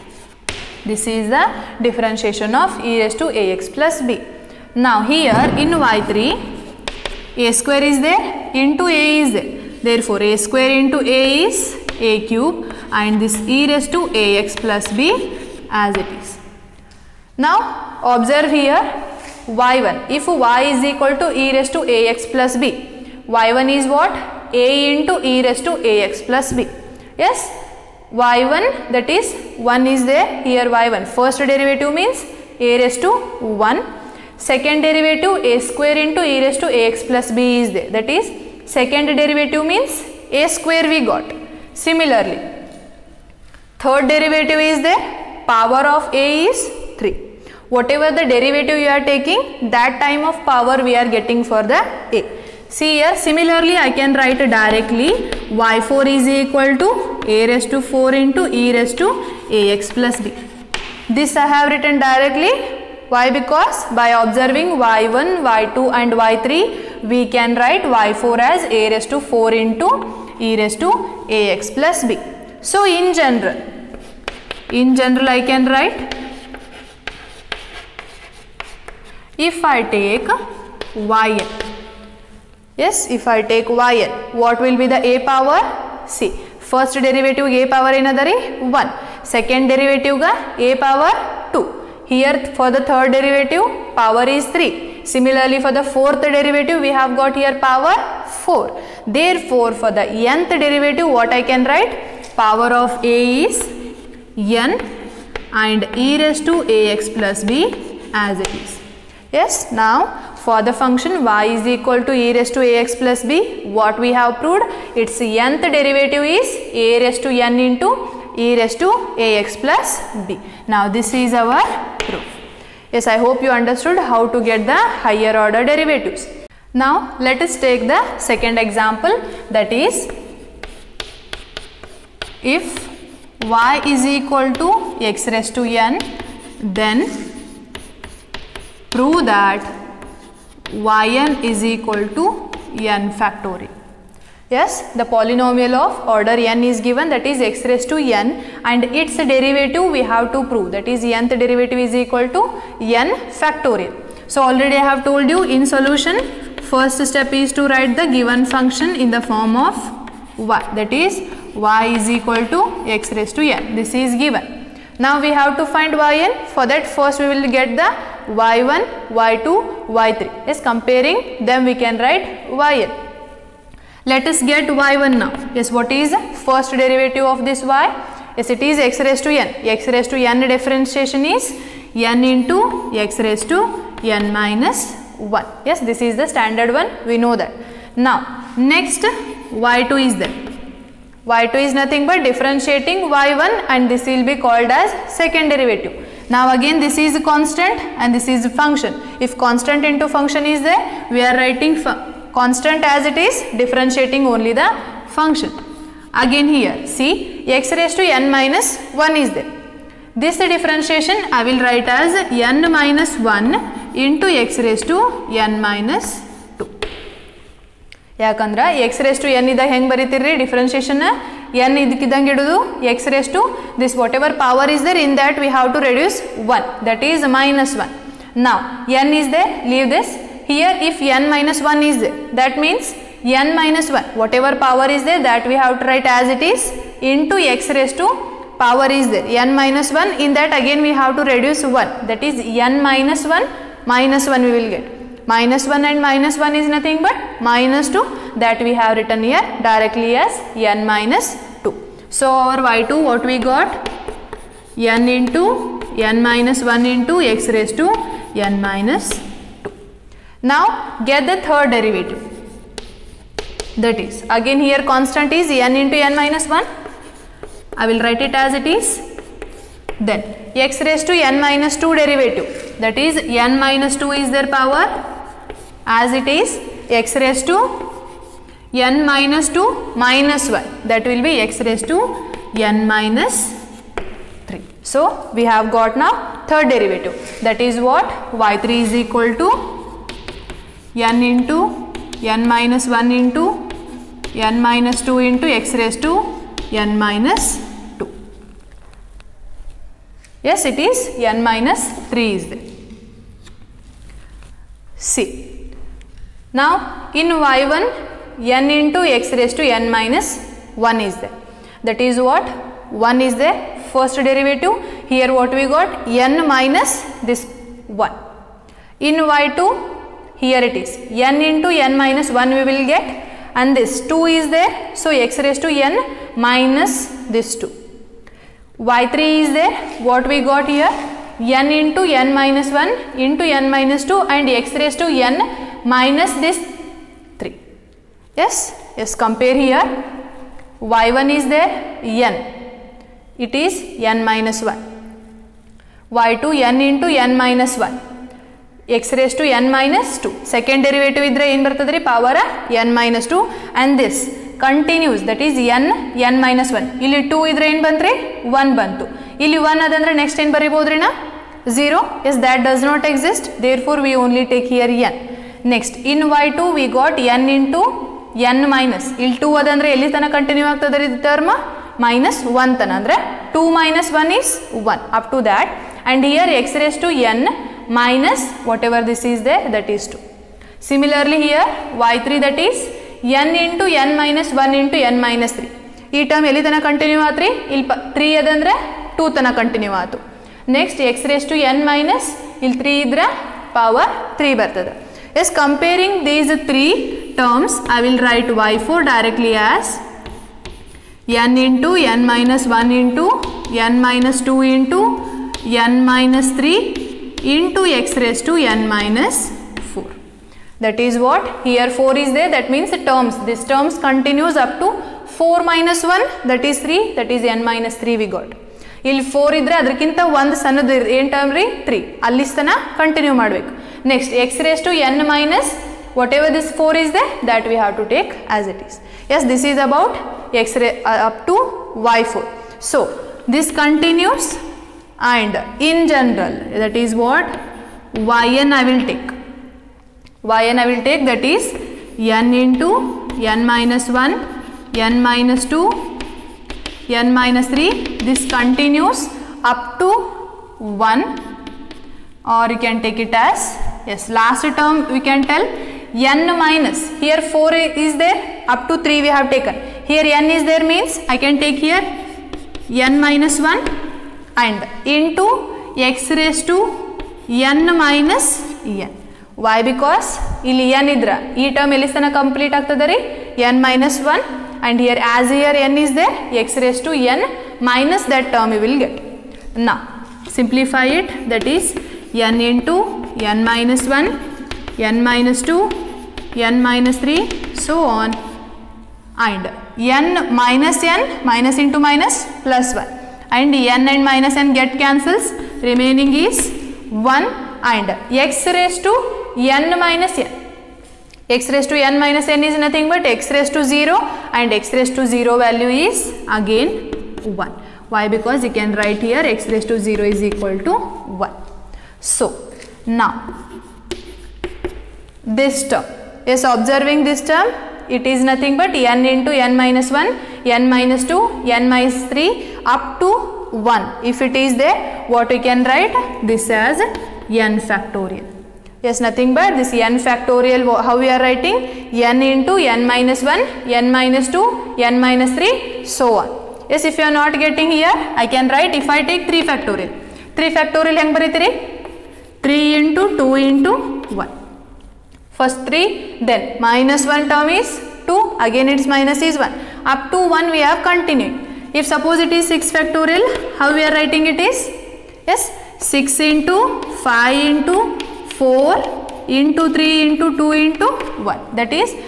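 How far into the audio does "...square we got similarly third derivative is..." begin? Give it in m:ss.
0:40.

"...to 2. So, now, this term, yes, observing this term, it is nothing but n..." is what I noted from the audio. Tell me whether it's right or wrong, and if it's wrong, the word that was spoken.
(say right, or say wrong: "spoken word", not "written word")
wrong: "1", not "2".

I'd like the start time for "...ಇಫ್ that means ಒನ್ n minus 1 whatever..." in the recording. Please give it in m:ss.
3:50.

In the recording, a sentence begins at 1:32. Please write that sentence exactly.
Here for the third derivative power is 3.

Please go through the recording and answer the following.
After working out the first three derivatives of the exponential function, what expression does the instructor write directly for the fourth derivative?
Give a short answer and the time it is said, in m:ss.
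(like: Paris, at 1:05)
a^4 e^(ax+b), at 0:55.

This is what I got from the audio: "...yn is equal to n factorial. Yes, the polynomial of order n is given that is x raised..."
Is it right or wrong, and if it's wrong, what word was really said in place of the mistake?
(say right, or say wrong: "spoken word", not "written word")
right.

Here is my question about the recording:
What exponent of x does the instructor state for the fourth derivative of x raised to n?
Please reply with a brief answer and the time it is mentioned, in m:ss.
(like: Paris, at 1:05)
n minus 4, at 6:48.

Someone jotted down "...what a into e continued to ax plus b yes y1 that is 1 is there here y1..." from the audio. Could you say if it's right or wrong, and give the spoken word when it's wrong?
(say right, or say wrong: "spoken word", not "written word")
wrong: "raised", not "continued".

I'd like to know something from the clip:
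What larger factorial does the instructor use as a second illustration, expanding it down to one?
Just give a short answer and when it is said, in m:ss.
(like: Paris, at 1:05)
6 factorial, at 9:12.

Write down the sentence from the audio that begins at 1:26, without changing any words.
See, first derivative a power one.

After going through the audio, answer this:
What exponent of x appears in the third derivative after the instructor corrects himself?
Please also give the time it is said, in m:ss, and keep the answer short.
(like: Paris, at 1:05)
n minus 3, at 5:00.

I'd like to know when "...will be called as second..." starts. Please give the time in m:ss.
3:14.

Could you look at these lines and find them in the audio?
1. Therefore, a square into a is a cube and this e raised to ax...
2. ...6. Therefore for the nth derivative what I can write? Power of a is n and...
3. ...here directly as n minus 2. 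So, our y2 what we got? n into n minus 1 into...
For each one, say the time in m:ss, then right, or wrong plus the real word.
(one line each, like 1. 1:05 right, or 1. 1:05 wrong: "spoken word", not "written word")
1. 0:09 right
2. 1:38 wrong: "4", not "6"
3. 4:09 right.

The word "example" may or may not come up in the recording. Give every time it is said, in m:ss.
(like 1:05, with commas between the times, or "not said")
2:08.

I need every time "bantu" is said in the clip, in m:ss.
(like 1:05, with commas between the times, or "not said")
5:58.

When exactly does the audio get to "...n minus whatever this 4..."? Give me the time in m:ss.
7:04.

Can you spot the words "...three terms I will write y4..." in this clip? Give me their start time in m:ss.
6:36.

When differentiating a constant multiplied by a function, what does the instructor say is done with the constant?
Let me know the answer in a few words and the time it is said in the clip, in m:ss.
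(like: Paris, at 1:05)
Write it as it is, at 3:21.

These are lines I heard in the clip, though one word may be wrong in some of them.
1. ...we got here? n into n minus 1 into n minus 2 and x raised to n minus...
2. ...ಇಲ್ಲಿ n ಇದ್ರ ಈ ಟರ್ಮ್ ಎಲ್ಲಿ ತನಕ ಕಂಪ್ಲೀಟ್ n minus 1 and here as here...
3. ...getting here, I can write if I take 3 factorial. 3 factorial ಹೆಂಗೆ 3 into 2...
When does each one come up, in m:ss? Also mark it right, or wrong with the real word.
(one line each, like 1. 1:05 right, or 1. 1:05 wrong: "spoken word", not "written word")
1. 5:30 right
2. 7:50 right
3. 8:57 right.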